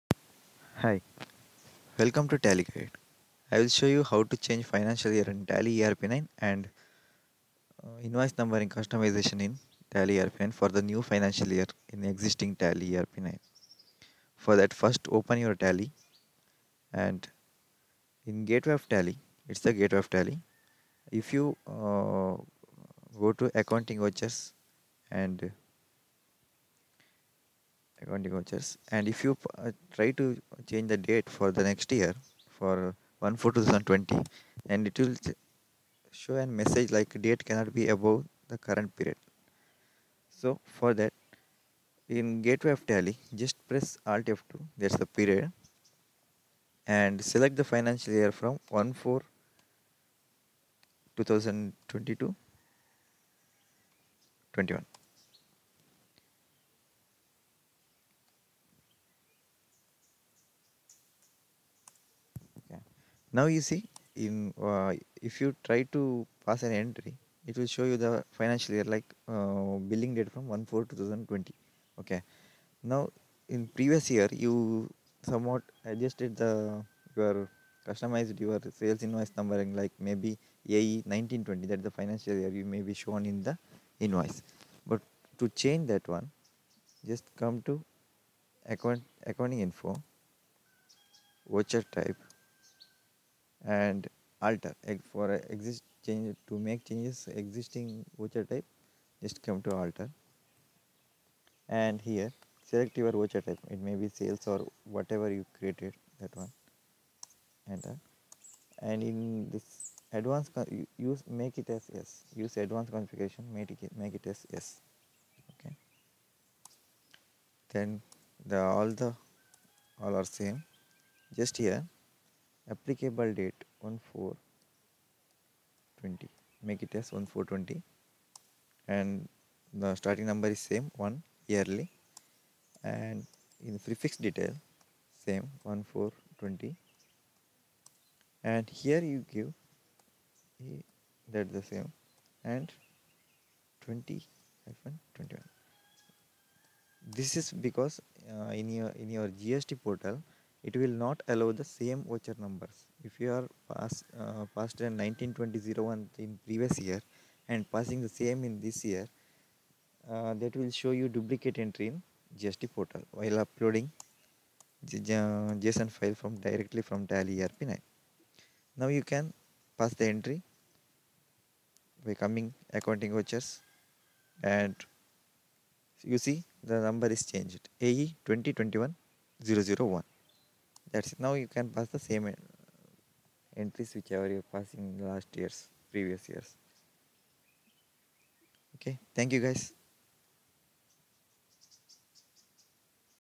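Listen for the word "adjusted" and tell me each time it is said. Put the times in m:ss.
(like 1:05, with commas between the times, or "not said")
1:15.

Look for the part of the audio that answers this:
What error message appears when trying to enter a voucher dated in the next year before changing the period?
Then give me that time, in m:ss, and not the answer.
0:37.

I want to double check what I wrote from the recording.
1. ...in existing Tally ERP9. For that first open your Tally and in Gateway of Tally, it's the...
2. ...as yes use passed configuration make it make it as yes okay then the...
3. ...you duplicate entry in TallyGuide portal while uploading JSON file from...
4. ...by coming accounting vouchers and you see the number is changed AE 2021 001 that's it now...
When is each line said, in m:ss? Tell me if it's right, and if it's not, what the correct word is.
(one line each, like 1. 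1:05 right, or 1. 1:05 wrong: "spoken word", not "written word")
1. 0:11 right
2. 1:51 wrong: "advanced", not "passed"
3. 2:40 wrong: "GST", not "TallyGuide"
4. 2:52 right.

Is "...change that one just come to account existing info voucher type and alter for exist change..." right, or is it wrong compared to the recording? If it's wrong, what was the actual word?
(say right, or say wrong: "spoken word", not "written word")
wrong: "accounting", not "existing".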